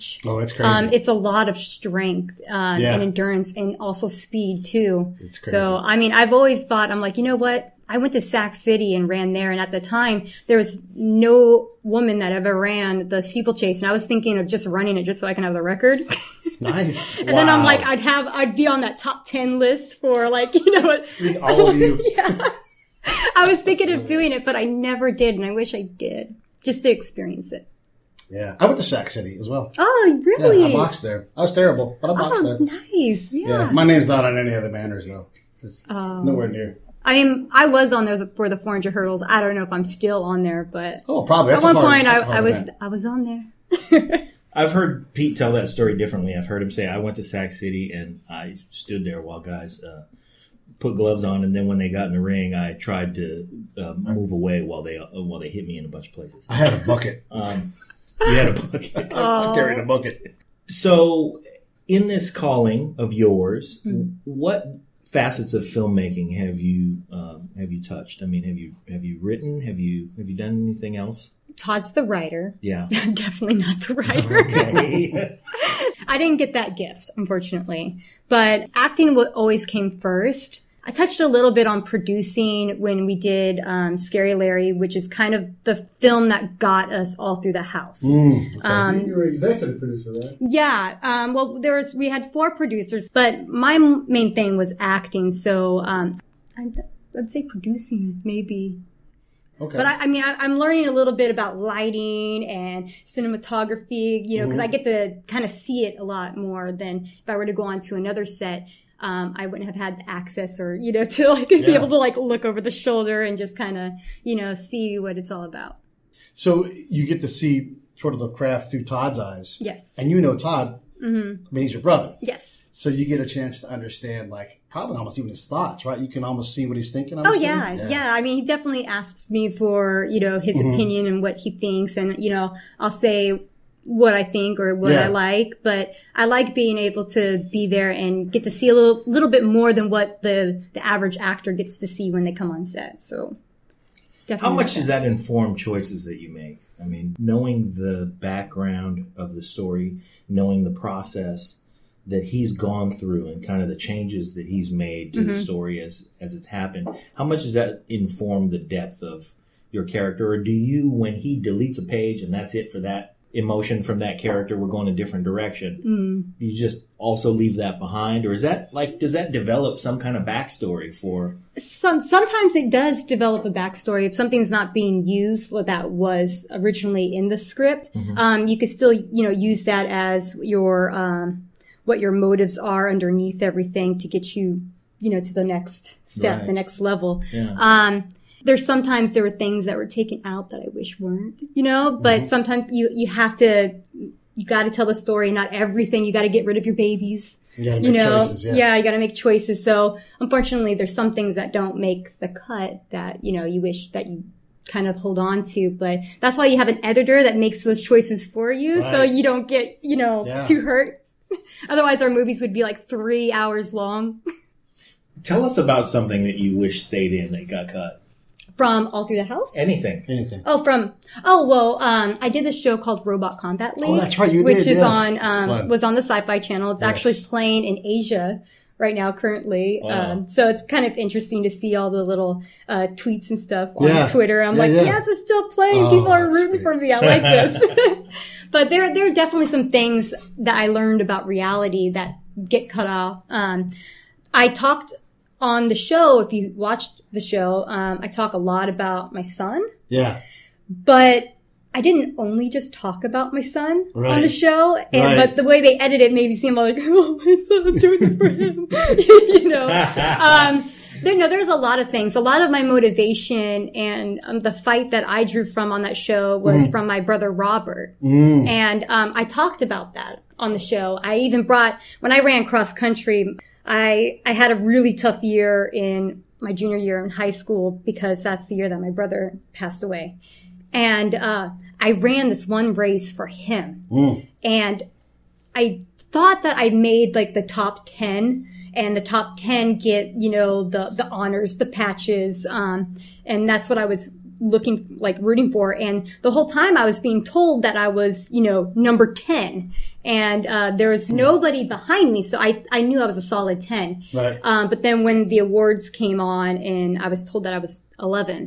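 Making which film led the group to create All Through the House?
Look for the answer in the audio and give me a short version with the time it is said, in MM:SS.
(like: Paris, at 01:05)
Scary Larry, at 01:23.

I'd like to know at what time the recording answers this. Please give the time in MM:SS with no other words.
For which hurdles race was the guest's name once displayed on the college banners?
00:38.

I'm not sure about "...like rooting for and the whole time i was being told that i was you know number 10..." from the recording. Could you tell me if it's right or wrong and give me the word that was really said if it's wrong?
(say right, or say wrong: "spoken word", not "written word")
right.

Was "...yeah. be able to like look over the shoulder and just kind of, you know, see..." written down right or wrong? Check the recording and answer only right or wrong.
right.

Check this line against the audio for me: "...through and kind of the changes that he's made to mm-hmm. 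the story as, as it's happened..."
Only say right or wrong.
right.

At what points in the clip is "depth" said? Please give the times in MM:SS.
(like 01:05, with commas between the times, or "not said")
02:38.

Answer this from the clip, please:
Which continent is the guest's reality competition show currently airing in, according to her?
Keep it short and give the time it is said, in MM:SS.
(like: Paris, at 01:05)
Asia, at 03:47.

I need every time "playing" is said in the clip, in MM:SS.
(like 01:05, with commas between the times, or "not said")
03:47, 03:55.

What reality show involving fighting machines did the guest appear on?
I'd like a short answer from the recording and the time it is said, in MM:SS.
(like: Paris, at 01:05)
Robot Combat League, at 03:43.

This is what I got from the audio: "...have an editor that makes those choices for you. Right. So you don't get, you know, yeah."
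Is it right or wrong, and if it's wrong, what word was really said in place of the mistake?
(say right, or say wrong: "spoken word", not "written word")
right.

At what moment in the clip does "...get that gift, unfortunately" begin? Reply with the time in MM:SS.
01:16.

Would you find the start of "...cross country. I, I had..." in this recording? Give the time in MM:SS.
04:32.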